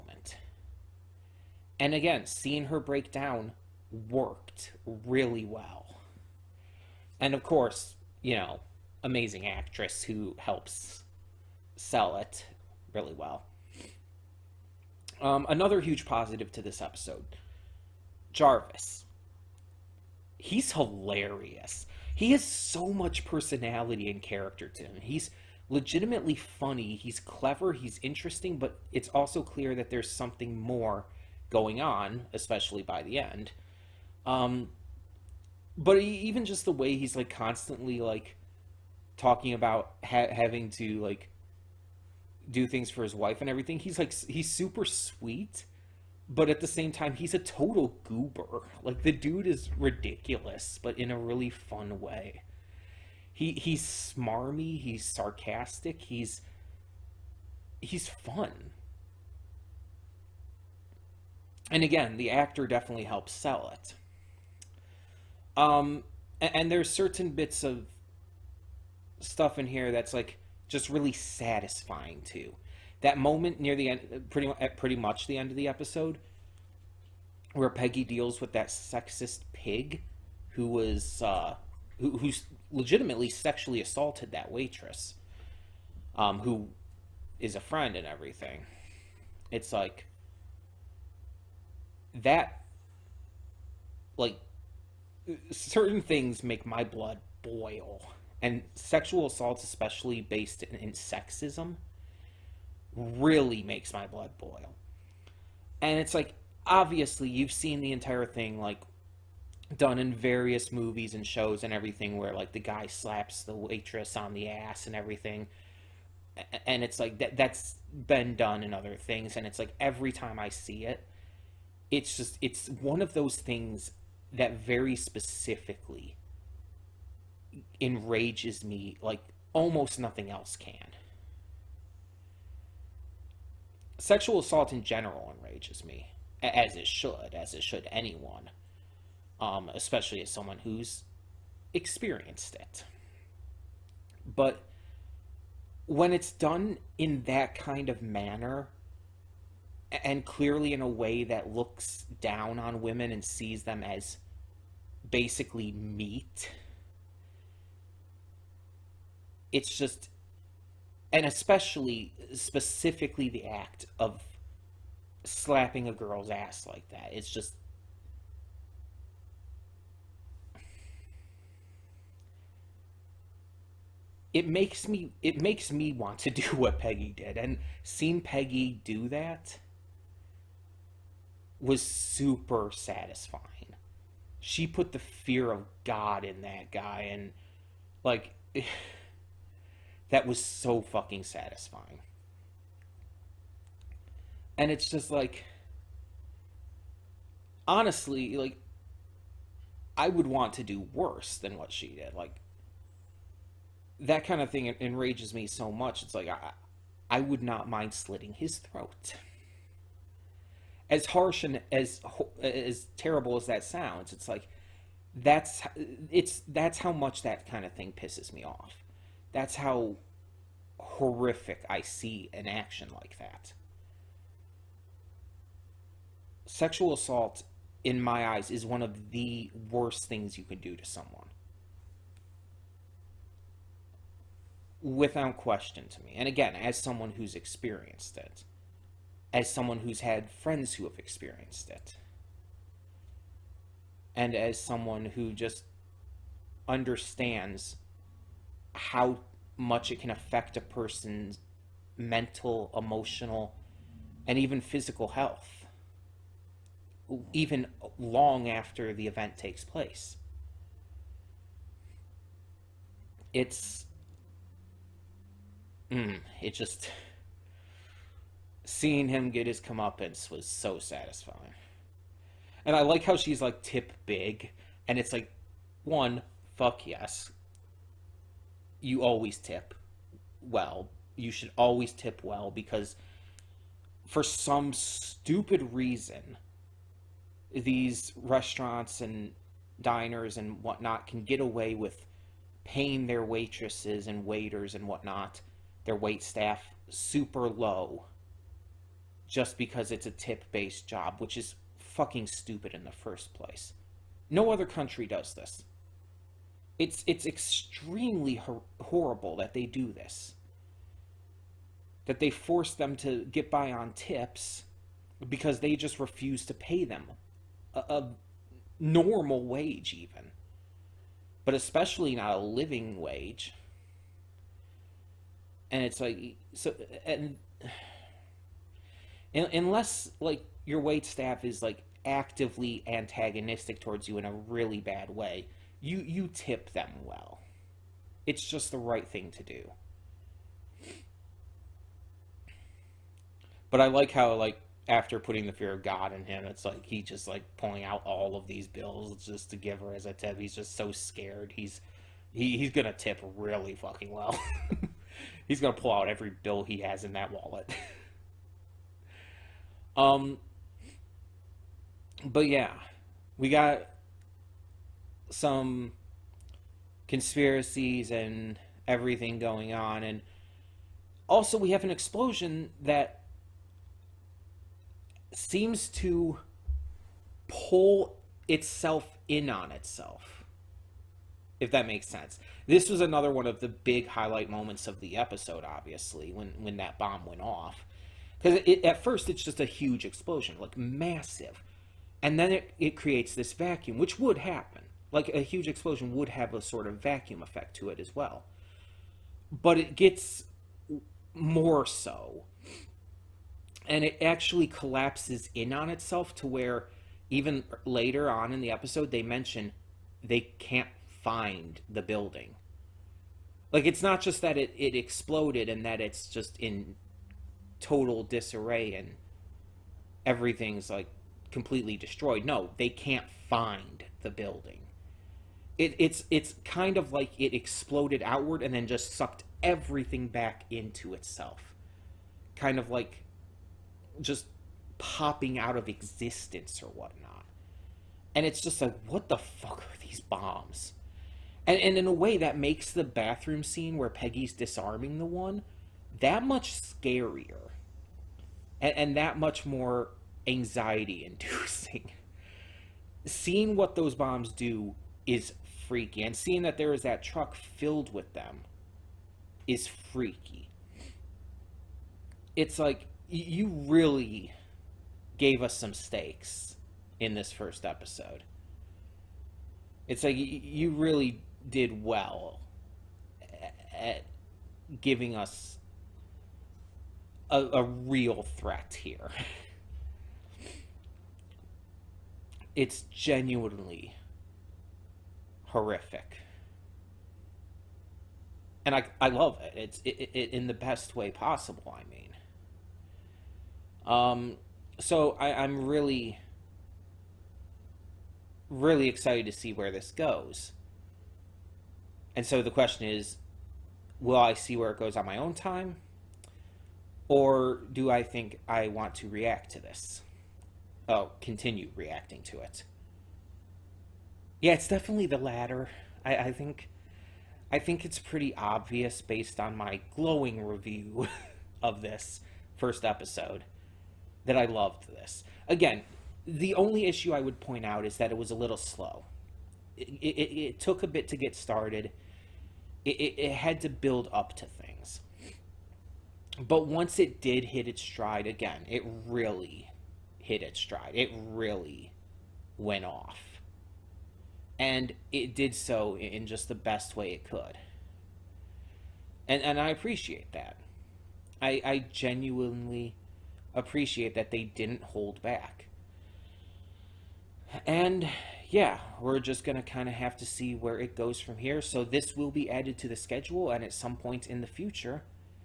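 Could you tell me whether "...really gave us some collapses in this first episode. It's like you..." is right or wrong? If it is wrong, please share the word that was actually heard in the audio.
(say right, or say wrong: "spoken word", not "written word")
wrong: "stakes", not "collapses".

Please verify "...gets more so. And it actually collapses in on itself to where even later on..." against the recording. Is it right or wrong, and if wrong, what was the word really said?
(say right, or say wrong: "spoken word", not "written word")
right.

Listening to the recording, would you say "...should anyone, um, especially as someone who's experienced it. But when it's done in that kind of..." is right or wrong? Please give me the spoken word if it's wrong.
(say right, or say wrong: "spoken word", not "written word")
right.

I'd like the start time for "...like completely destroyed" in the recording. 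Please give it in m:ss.
7:00.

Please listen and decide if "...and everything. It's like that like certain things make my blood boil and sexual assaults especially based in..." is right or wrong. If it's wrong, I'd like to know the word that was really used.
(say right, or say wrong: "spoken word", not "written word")
right.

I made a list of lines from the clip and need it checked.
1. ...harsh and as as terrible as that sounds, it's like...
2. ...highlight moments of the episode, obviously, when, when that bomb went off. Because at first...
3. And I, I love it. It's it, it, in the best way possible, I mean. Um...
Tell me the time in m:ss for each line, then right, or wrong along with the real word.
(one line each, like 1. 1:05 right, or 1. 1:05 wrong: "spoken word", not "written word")
1. 3:31 right
2. 6:24 right
3. 8:08 right.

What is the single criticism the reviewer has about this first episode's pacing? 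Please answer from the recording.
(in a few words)
A little slow.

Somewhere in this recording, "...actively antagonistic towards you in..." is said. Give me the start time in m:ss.
5:32.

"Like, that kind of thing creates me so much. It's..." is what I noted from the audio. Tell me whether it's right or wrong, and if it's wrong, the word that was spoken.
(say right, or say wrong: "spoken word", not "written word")
wrong: "enrages", not "creates".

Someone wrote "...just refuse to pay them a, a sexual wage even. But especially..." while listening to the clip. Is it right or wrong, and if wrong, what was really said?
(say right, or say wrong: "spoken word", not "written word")
wrong: "normal", not "sexual".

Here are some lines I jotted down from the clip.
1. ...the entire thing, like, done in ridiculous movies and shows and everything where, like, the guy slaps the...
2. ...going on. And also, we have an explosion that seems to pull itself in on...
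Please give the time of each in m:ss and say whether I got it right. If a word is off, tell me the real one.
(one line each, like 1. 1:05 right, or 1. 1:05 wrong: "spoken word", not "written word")
1. 1:47 wrong: "various", not "ridiculous"
2. 6:09 right.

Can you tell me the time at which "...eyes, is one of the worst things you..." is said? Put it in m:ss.
3:48.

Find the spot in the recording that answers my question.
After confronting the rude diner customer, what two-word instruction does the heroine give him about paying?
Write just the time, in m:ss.
4:33.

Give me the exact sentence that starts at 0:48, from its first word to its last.
Like the dude is ridiculous, but in a really fun way.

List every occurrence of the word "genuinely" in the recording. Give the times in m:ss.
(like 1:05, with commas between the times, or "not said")
8:03, 9:12.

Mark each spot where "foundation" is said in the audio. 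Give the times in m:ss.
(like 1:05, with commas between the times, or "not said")
not said.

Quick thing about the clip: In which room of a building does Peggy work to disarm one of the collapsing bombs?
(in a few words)
Bathroom.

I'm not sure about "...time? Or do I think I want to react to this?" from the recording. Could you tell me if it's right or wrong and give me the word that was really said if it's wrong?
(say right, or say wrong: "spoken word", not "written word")
right.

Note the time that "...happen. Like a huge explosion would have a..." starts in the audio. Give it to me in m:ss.
6:34.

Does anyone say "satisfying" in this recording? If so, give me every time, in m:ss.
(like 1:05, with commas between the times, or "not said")
1:11, 3:02, 3:11, 4:30.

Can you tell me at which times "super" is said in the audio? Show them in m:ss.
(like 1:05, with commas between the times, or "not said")
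0:44, 3:01, 4:56.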